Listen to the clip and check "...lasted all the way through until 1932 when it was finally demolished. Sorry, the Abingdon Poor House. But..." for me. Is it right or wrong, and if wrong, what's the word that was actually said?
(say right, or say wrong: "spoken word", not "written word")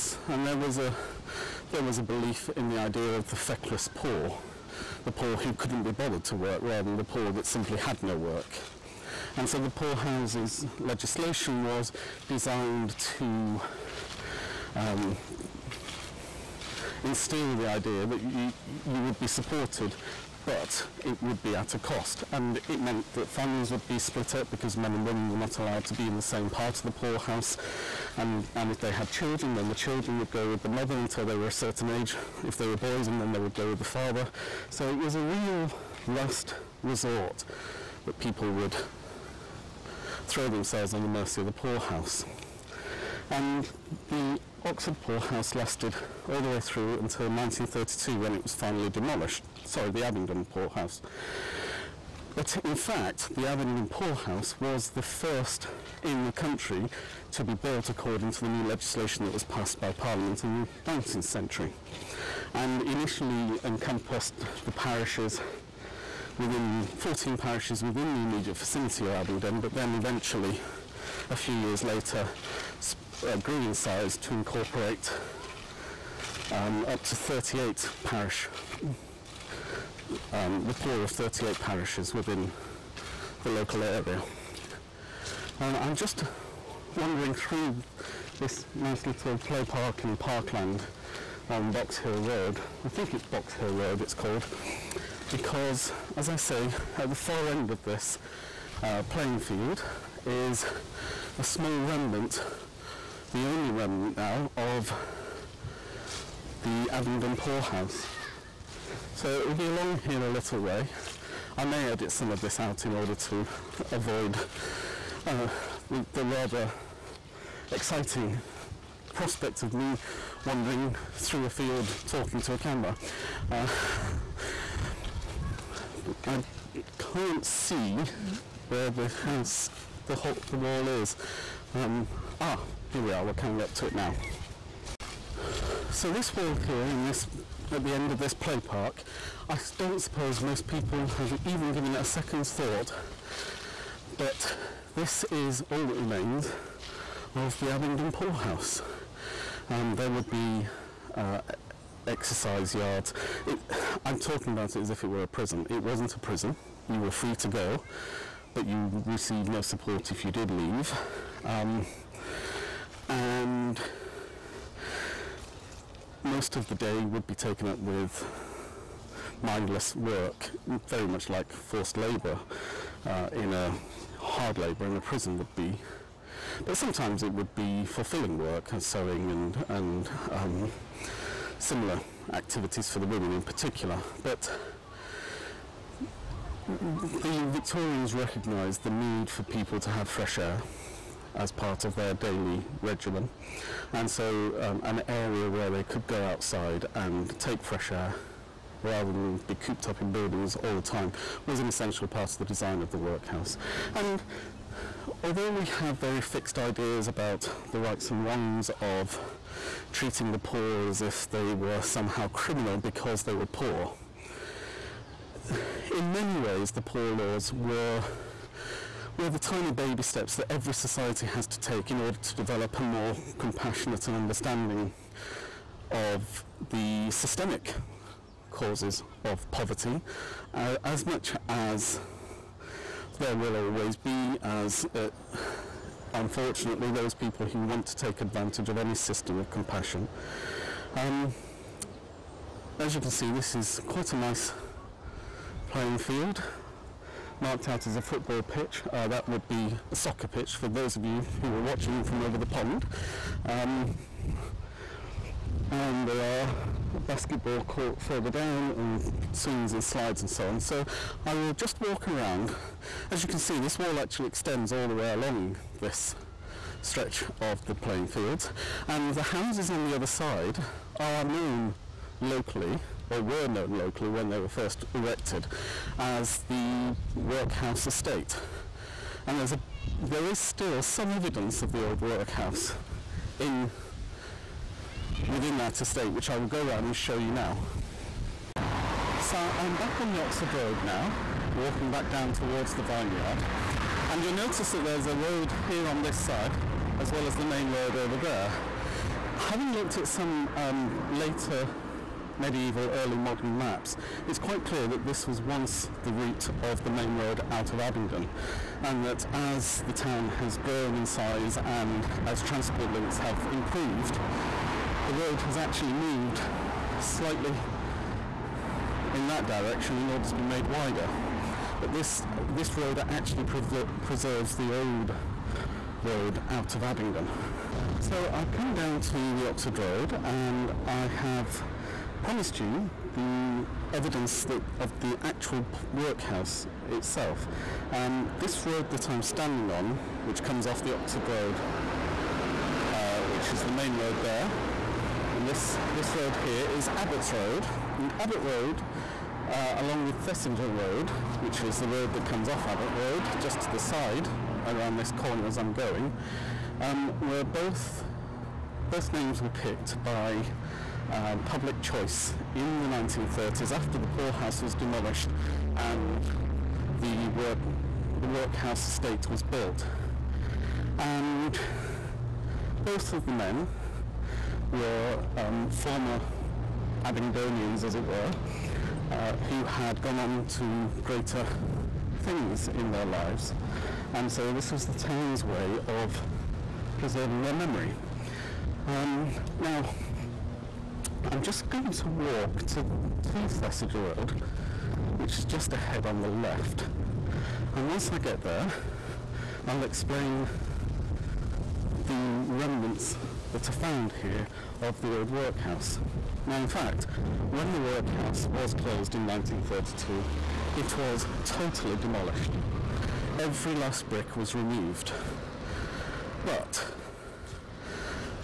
right.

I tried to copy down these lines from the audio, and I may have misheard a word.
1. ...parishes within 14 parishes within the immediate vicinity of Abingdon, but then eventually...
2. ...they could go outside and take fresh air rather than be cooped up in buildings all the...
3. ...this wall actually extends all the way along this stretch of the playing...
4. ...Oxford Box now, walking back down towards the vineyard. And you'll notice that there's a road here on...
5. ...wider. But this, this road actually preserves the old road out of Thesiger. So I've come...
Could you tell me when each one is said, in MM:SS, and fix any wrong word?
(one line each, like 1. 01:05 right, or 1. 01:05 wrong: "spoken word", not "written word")
1. 01:04 right
2. 03:15 right
3. 04:23 right
4. 04:50 wrong: "Road", not "Box"
5. 05:20 wrong: "Abingdon", not "Thesiger".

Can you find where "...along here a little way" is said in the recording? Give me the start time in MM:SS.
01:49.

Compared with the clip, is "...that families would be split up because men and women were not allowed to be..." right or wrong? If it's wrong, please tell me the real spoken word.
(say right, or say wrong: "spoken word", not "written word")
right.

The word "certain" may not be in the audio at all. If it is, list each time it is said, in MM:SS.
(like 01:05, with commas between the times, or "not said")
00:31.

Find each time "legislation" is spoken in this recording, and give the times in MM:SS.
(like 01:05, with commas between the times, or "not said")
00:10, 00:58.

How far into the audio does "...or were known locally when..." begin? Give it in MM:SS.
04:33.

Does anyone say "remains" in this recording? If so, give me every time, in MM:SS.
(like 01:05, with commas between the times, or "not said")
02:25.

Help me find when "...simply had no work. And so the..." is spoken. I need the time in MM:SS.
00:07.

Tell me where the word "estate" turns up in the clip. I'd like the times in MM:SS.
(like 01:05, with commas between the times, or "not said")
04:37, 04:45, 06:08.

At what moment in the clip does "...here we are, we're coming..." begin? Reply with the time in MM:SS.
02:12.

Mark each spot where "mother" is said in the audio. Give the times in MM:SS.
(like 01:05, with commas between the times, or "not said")
00:30.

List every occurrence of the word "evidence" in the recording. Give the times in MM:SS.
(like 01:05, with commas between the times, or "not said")
04:41, 05:33.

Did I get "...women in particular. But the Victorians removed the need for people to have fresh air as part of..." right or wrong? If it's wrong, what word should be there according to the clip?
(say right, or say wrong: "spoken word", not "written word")
wrong: "recognised", not "removed".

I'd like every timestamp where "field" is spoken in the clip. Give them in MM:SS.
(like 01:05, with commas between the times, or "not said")
01:39, 02:01, 04:05, 04:28.